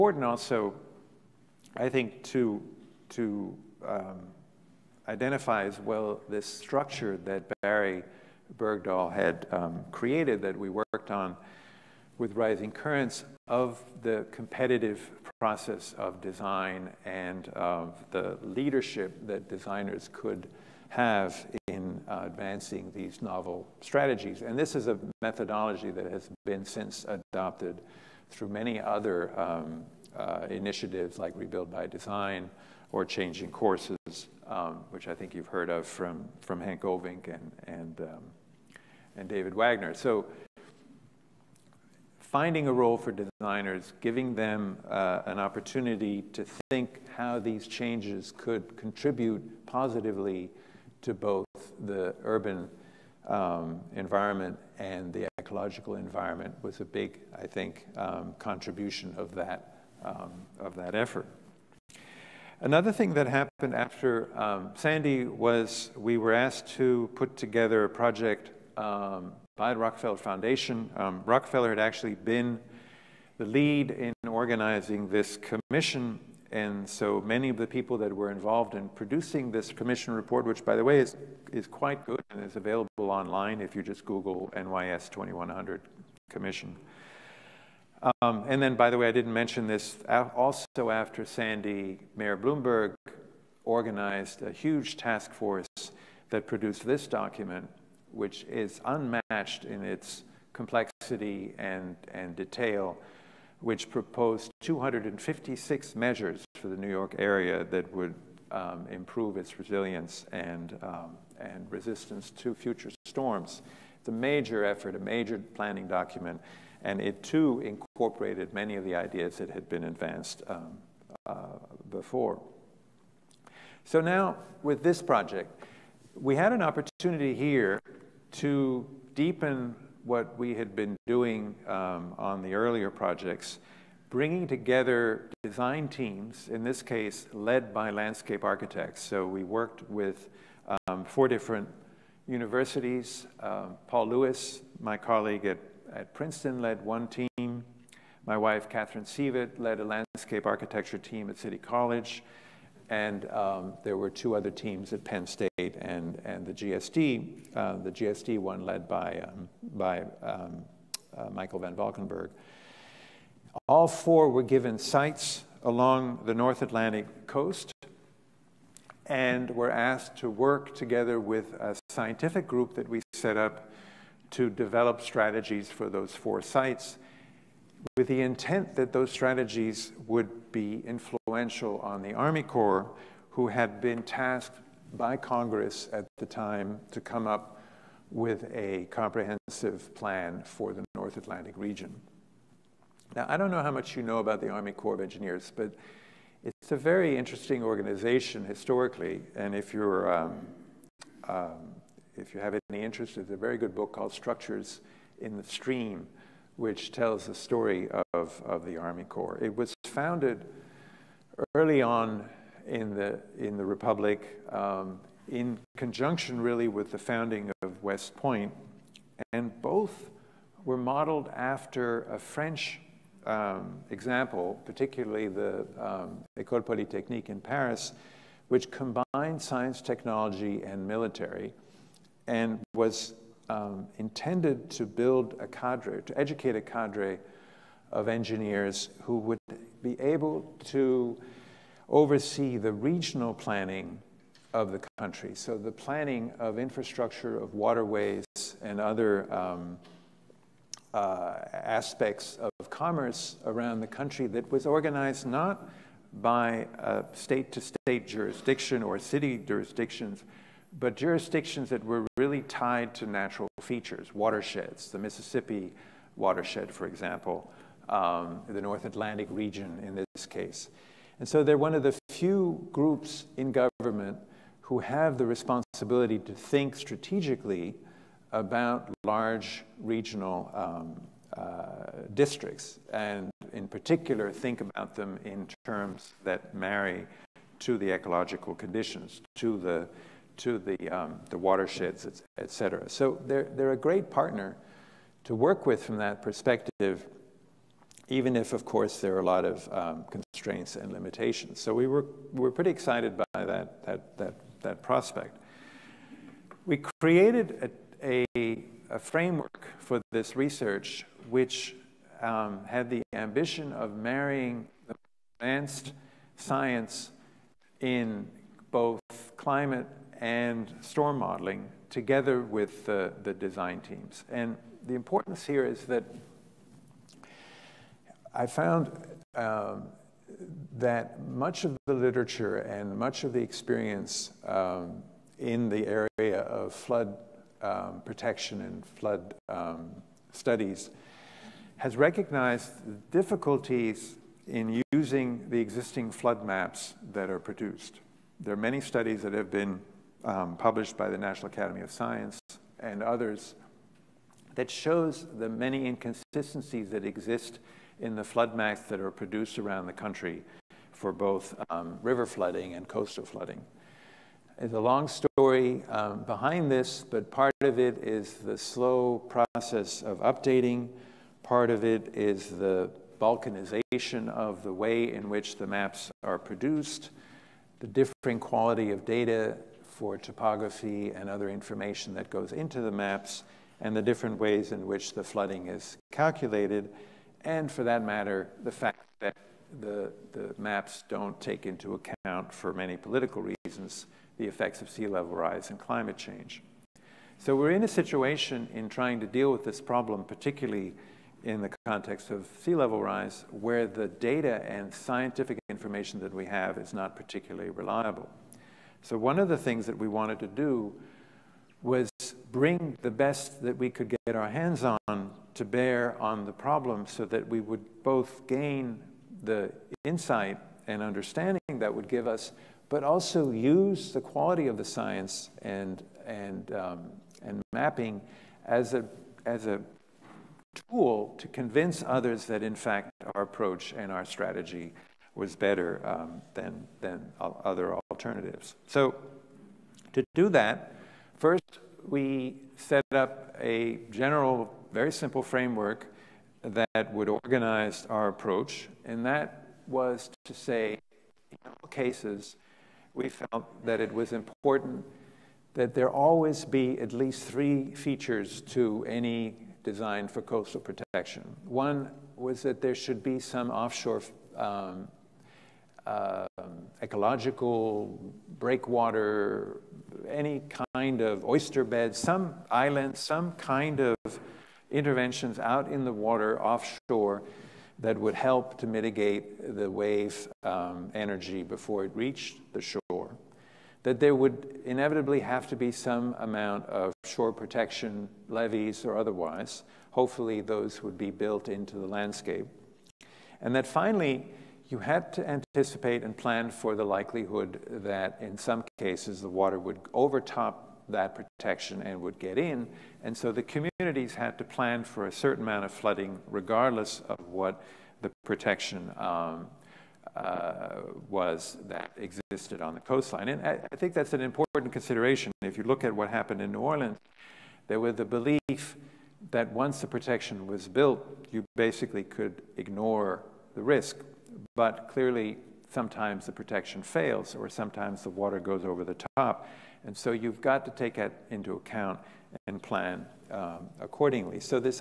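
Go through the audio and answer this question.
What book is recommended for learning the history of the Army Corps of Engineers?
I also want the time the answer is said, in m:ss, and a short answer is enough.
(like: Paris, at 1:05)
Structures in the Stream, at 3:24.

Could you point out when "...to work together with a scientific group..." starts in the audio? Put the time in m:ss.
2:50.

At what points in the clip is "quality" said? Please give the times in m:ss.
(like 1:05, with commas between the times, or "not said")
6:18, 7:04.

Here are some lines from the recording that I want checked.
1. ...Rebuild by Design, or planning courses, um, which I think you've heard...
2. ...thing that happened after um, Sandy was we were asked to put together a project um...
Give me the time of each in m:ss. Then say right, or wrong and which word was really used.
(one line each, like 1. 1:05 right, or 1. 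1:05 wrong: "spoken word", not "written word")
1. 0:31 wrong: "changing", not "planning"
2. 1:02 right.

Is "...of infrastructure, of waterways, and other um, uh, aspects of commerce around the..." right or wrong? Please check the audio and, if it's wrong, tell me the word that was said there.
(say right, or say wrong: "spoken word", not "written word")
right.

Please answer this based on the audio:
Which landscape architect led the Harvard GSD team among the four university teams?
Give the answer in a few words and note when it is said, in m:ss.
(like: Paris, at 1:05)
Michael van Valkenburgh, at 2:41.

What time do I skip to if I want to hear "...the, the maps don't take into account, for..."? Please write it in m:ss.
6:29.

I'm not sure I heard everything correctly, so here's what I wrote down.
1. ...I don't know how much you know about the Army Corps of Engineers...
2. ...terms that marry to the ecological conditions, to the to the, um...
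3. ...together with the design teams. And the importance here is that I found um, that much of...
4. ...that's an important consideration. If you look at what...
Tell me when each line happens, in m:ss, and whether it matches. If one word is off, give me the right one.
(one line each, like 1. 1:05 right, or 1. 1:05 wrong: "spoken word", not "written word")
1. 3:13 right
2. 4:45 right
3. 5:21 right
4. 8:34 right.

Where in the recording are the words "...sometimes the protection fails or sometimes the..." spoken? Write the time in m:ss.
8:45.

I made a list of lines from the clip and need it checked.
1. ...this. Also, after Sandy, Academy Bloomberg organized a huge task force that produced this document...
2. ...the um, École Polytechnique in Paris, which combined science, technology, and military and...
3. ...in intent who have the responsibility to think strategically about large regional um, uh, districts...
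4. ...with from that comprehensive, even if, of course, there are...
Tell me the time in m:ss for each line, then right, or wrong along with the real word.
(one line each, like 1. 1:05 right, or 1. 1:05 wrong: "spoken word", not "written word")
1. 1:29 wrong: "Mayor", not "Academy"
2. 3:45 right
3. 4:33 wrong: "government", not "intent"
4. 4:55 wrong: "perspective", not "comprehensive".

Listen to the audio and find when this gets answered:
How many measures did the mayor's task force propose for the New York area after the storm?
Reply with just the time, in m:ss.
1:44.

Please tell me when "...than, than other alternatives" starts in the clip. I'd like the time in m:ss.
7:16.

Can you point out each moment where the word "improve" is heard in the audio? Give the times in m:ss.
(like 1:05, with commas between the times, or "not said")
1:48.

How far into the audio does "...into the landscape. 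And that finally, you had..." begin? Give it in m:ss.
8:11.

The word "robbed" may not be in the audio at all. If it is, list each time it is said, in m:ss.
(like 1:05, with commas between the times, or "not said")
not said.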